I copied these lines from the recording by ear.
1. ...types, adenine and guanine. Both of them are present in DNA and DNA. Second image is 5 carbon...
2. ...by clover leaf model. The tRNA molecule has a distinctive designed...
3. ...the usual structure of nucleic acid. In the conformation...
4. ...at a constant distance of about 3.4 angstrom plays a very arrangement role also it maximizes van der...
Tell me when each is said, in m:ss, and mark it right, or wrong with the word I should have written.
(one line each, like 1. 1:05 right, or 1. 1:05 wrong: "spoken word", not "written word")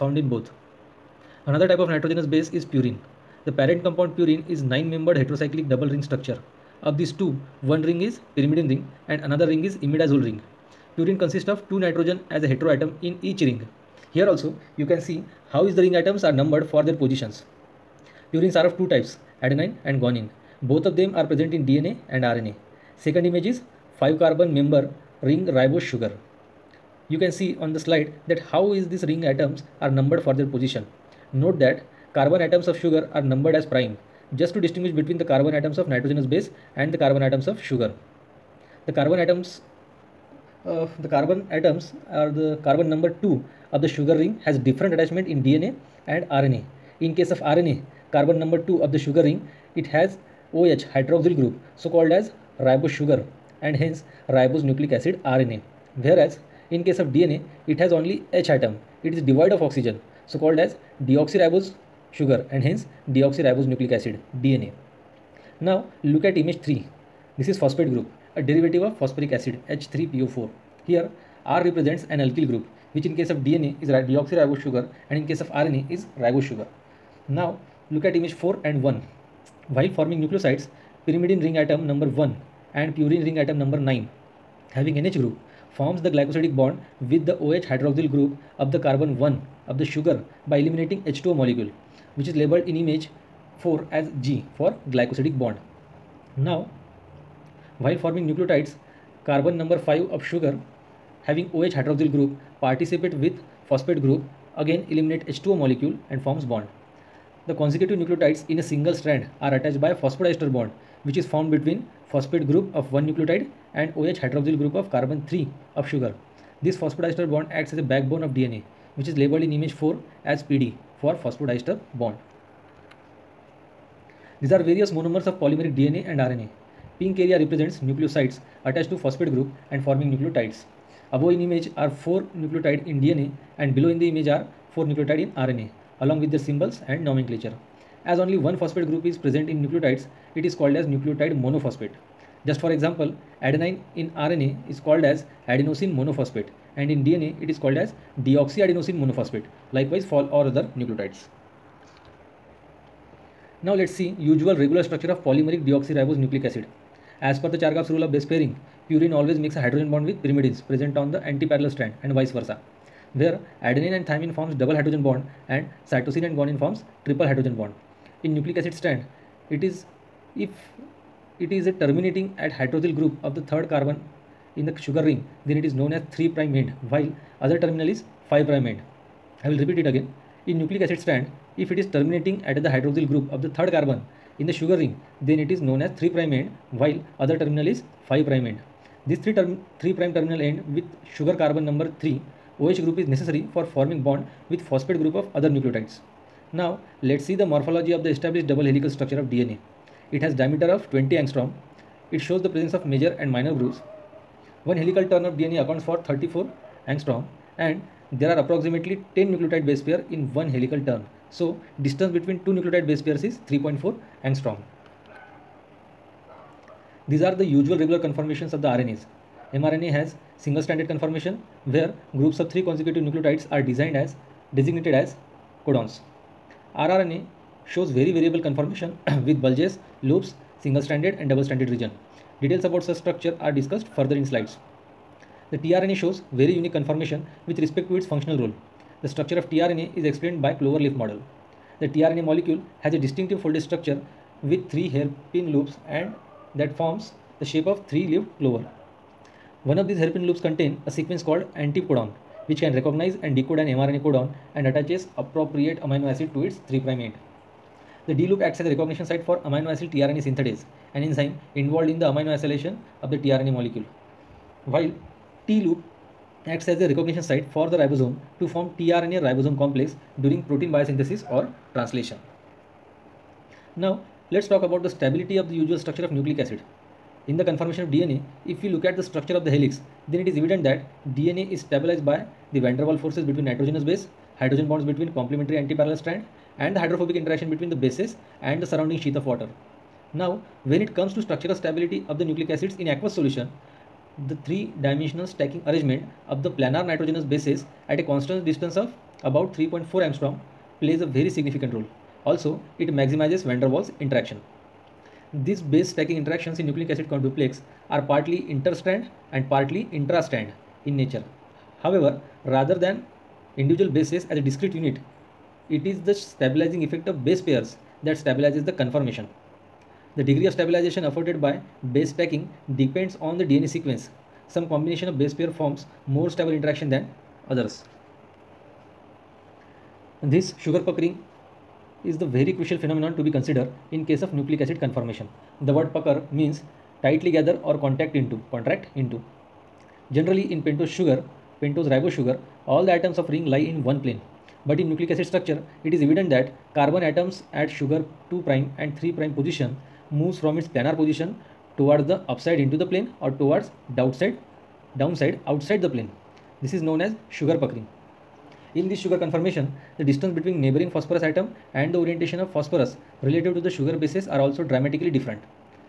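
1. 0:18 wrong: "RNA", not "DNA"
2. 4:00 wrong: "folded", not "designed"
3. 4:35 right
4. 4:57 wrong: "significant", not "arrangement".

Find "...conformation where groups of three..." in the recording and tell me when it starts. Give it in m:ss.
3:40.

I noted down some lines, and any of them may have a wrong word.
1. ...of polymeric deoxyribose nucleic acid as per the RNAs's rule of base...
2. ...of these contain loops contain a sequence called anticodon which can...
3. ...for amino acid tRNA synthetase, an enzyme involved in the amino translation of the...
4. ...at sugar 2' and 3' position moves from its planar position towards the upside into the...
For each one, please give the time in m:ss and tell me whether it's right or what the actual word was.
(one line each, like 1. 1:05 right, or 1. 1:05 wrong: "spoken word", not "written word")
1. 2:35 wrong: "Chargaff", not "RNAs"
2. 4:09 wrong: "hairpin", not "contain"
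3. 4:19 wrong: "acylation", not "translation"
4. 5:47 right.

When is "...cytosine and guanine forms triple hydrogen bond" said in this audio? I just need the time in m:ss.
2:45.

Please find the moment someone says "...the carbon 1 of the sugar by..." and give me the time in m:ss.
1:28.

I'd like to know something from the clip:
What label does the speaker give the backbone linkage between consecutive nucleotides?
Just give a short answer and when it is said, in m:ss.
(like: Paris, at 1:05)
PD, at 2:00.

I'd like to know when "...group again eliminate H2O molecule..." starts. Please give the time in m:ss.
1:44.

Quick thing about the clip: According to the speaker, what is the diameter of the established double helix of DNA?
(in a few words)
20 angstrom.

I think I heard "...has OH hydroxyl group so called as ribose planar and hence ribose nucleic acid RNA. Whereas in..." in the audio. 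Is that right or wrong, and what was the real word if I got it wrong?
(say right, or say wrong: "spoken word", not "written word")
wrong: "sugar", not "planar".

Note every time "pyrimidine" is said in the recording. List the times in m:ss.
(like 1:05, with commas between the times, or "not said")
0:08, 1:21, 2:40.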